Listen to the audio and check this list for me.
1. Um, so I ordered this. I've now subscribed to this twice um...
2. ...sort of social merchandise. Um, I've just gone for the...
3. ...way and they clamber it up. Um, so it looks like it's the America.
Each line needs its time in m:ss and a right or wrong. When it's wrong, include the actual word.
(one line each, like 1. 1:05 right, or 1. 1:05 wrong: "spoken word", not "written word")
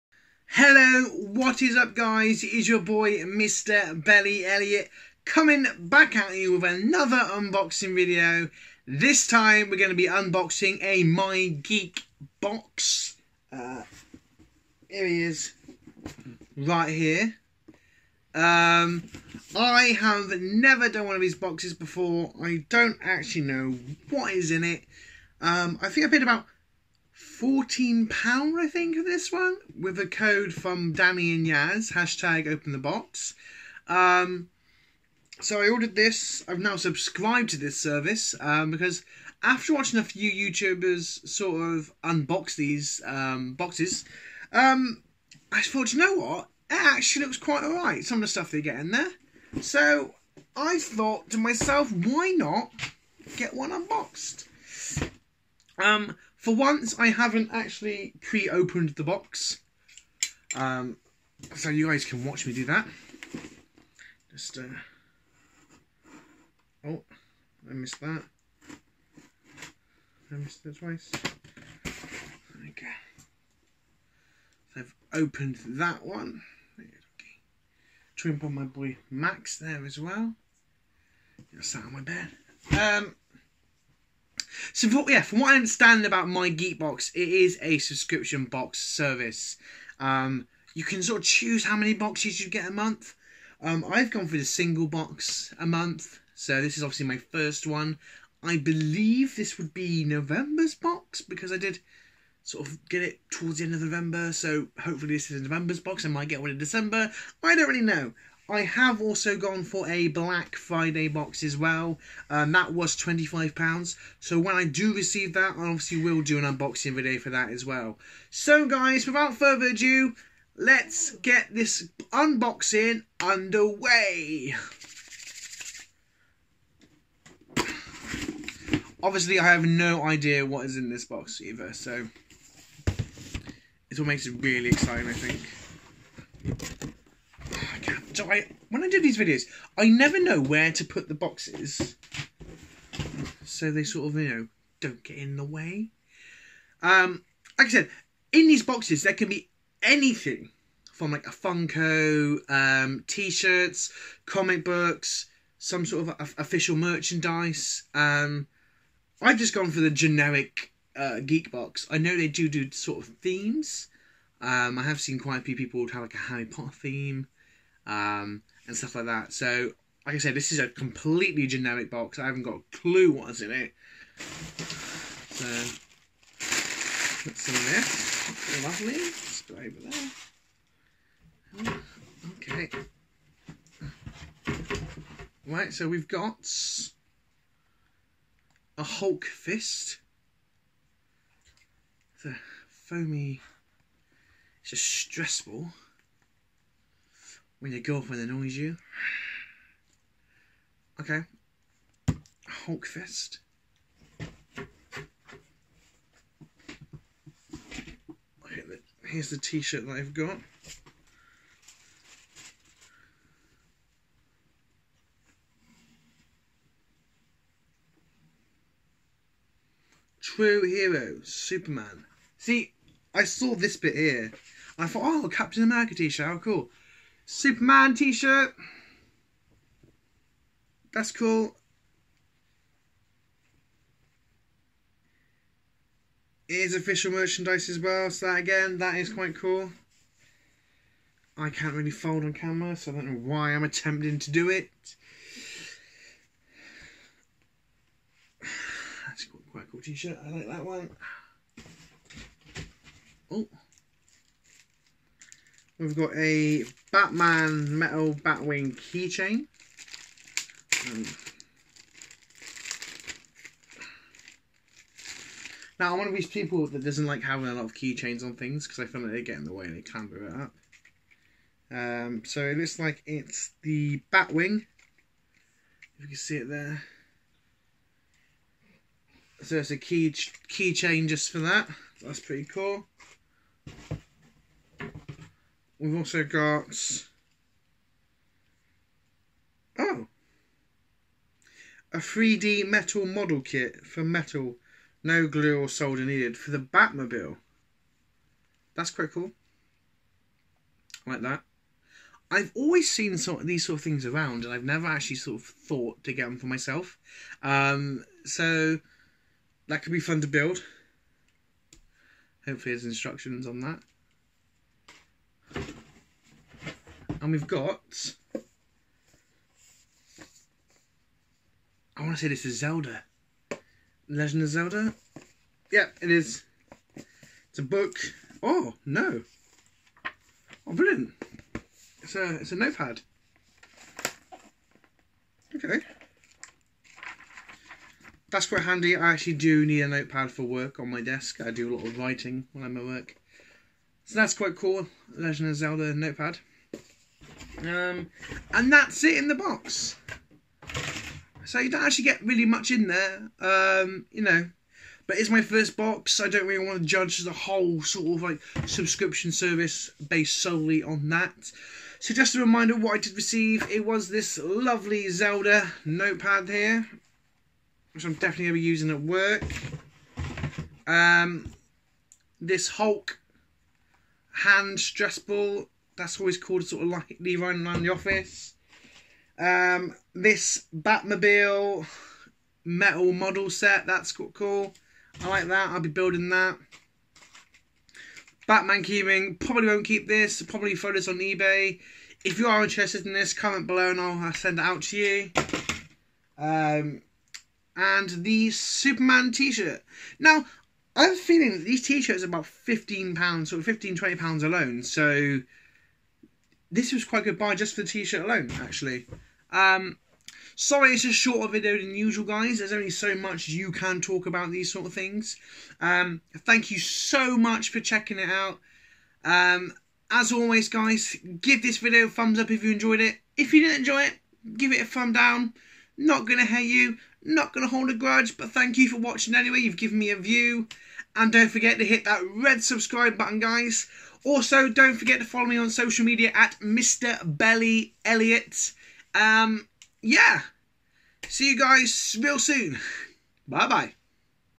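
1. 0:33 wrong: "service", not "twice"
2. 2:35 wrong: "official", not "social"
3. 4:29 wrong: "Batwing", not "America".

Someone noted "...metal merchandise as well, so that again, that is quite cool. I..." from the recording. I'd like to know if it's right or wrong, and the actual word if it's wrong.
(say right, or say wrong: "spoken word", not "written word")
wrong: "official", not "metal".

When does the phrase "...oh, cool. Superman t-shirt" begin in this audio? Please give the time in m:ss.
3:46.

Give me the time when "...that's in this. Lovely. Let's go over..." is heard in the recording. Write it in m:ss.
2:57.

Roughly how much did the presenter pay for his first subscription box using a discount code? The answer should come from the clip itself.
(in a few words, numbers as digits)
£14.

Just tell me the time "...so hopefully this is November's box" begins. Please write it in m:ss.
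1:44.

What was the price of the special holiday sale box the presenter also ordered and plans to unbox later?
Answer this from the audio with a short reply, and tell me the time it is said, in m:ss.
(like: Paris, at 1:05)
£25, at 1:52.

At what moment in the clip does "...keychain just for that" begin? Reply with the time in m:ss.
4:40.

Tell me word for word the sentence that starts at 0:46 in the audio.
It actually looks quite alright, some of the stuff they get in there.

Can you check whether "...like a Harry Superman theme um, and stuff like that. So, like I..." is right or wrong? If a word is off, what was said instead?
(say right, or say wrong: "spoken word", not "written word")
wrong: "Potter", not "Superman".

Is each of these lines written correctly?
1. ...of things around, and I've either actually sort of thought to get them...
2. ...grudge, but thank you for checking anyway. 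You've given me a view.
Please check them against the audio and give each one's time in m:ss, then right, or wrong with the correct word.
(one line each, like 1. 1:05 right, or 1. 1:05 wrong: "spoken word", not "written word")
1. 5:03 wrong: "never", not "either"
2. 7:07 wrong: "watching", not "checking".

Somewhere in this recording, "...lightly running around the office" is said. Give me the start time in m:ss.
6:16.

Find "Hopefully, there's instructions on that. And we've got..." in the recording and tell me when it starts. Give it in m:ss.
5:12.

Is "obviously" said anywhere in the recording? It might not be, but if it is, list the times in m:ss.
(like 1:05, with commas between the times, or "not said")
1:36, 1:55, 2:09.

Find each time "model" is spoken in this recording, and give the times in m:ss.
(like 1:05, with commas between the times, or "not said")
4:53, 6:23.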